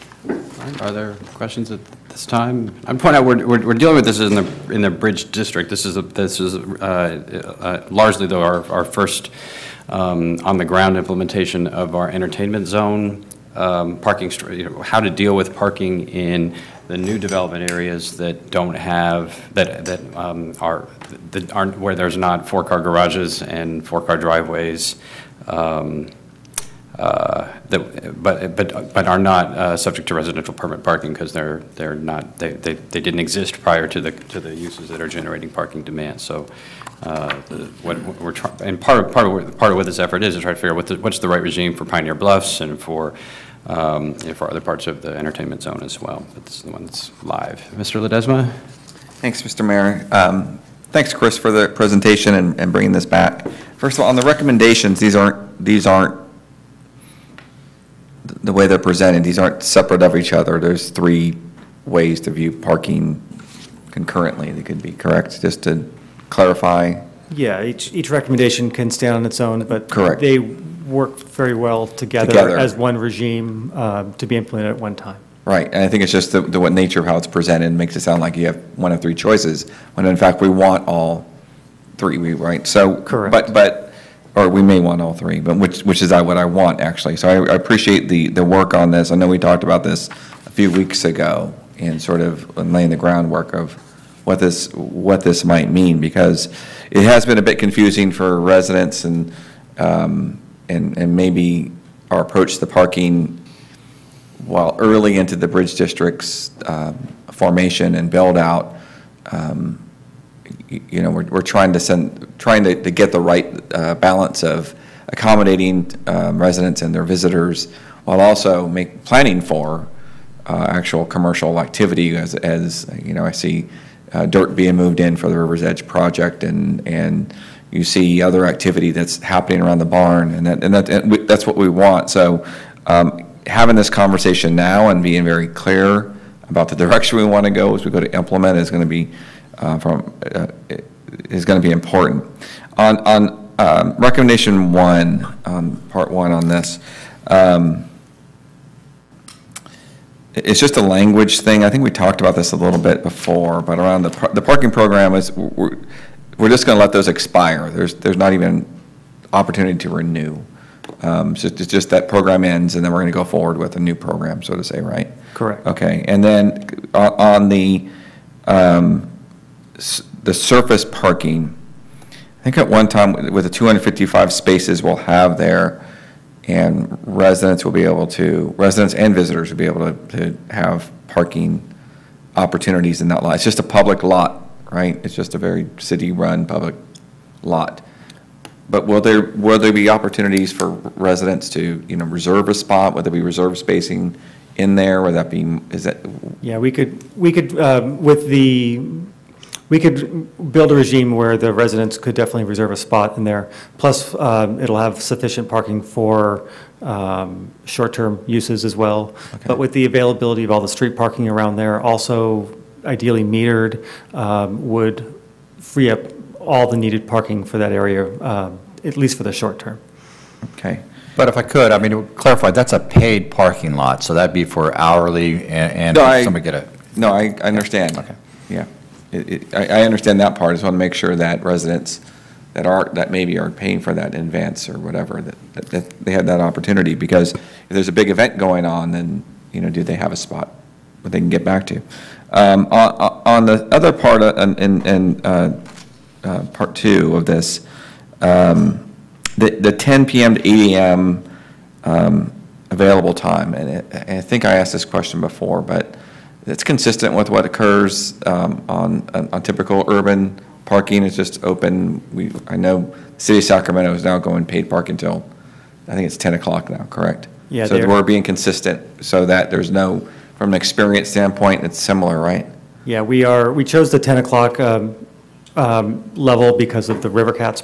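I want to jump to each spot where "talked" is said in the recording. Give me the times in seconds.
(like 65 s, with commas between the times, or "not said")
89 s, 151 s.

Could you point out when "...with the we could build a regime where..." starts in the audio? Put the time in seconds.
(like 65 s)
197 s.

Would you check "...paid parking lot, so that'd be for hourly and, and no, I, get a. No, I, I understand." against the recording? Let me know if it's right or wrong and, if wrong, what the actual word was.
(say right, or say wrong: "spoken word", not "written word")
right.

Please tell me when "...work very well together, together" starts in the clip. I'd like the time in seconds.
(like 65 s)
70 s.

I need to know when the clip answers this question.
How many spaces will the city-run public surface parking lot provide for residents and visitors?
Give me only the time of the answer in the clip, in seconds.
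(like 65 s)
173 s.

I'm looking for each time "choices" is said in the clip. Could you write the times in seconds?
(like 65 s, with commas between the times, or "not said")
79 s.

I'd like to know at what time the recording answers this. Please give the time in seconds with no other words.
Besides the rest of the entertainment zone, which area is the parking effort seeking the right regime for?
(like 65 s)
41 s.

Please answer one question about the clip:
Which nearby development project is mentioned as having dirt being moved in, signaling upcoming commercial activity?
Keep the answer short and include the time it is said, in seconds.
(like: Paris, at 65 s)
River's Edge, at 125 s.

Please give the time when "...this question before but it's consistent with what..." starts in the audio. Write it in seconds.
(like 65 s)
254 s.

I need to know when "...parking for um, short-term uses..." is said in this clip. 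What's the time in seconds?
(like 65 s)
205 s.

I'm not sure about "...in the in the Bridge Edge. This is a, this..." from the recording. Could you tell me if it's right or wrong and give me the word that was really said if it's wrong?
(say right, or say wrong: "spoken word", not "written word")
wrong: "District", not "Edge".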